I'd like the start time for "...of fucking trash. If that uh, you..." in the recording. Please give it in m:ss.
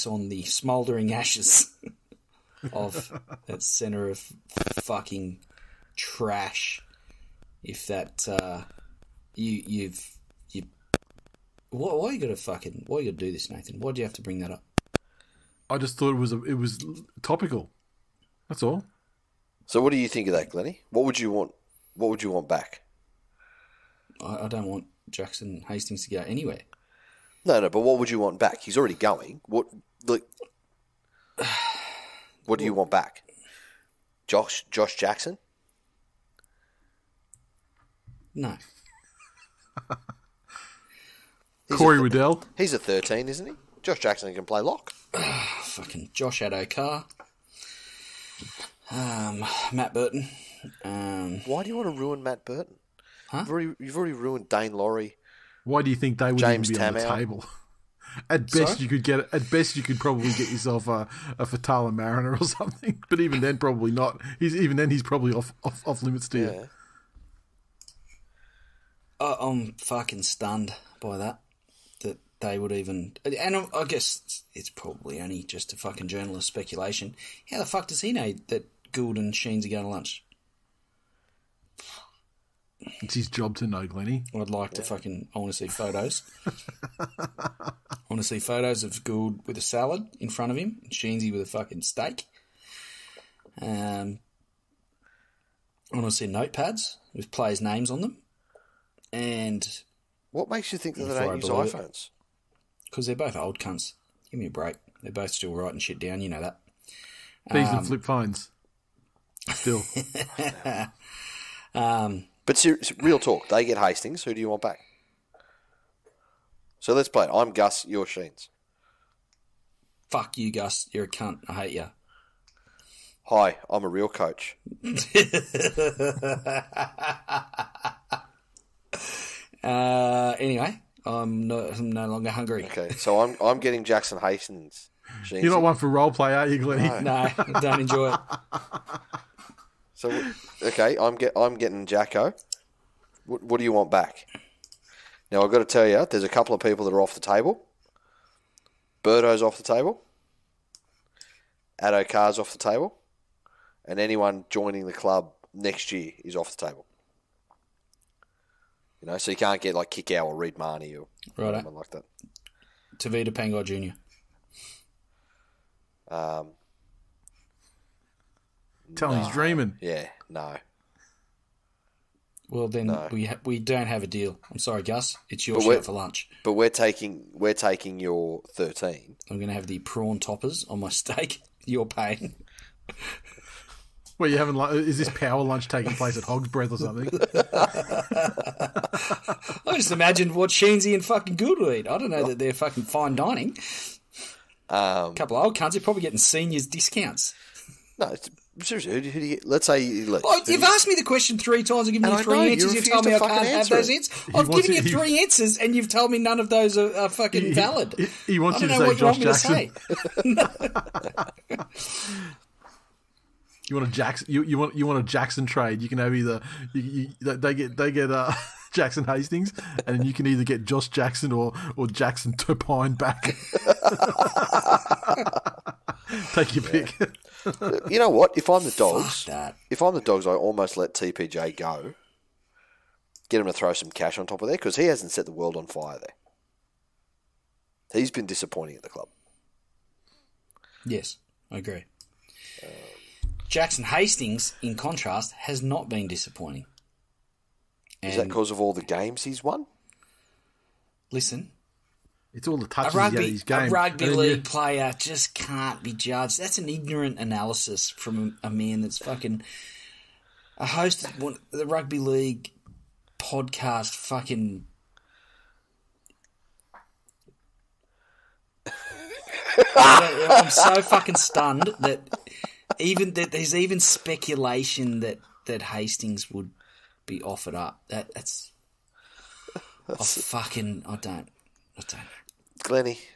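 0:04.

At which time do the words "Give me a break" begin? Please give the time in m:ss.
1:44.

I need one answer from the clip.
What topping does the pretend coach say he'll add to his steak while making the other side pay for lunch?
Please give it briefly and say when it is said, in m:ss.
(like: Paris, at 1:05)
prawn toppers, at 2:59.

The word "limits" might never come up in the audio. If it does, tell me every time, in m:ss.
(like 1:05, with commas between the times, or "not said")
1:06.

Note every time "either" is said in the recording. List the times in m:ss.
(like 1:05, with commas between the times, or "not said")
3:36, 3:40.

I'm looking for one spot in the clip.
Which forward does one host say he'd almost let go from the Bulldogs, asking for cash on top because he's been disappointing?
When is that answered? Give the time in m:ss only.
3:50.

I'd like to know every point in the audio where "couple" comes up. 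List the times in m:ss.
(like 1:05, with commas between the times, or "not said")
2:26, 3:15.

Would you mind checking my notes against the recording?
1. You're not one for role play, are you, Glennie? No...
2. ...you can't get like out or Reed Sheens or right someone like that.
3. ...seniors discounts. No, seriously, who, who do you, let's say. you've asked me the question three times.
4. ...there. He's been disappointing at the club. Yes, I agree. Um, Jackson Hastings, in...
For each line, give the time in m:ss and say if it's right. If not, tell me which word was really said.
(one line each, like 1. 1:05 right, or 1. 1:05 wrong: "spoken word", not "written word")
1. 2:15 right
2. 2:39 wrong: "Mahoney", not "Sheens"
3. 3:16 right
4. 3:55 right.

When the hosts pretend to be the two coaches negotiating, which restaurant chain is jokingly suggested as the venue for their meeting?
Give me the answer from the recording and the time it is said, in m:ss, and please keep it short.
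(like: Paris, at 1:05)
Hog's Breath, at 3:06.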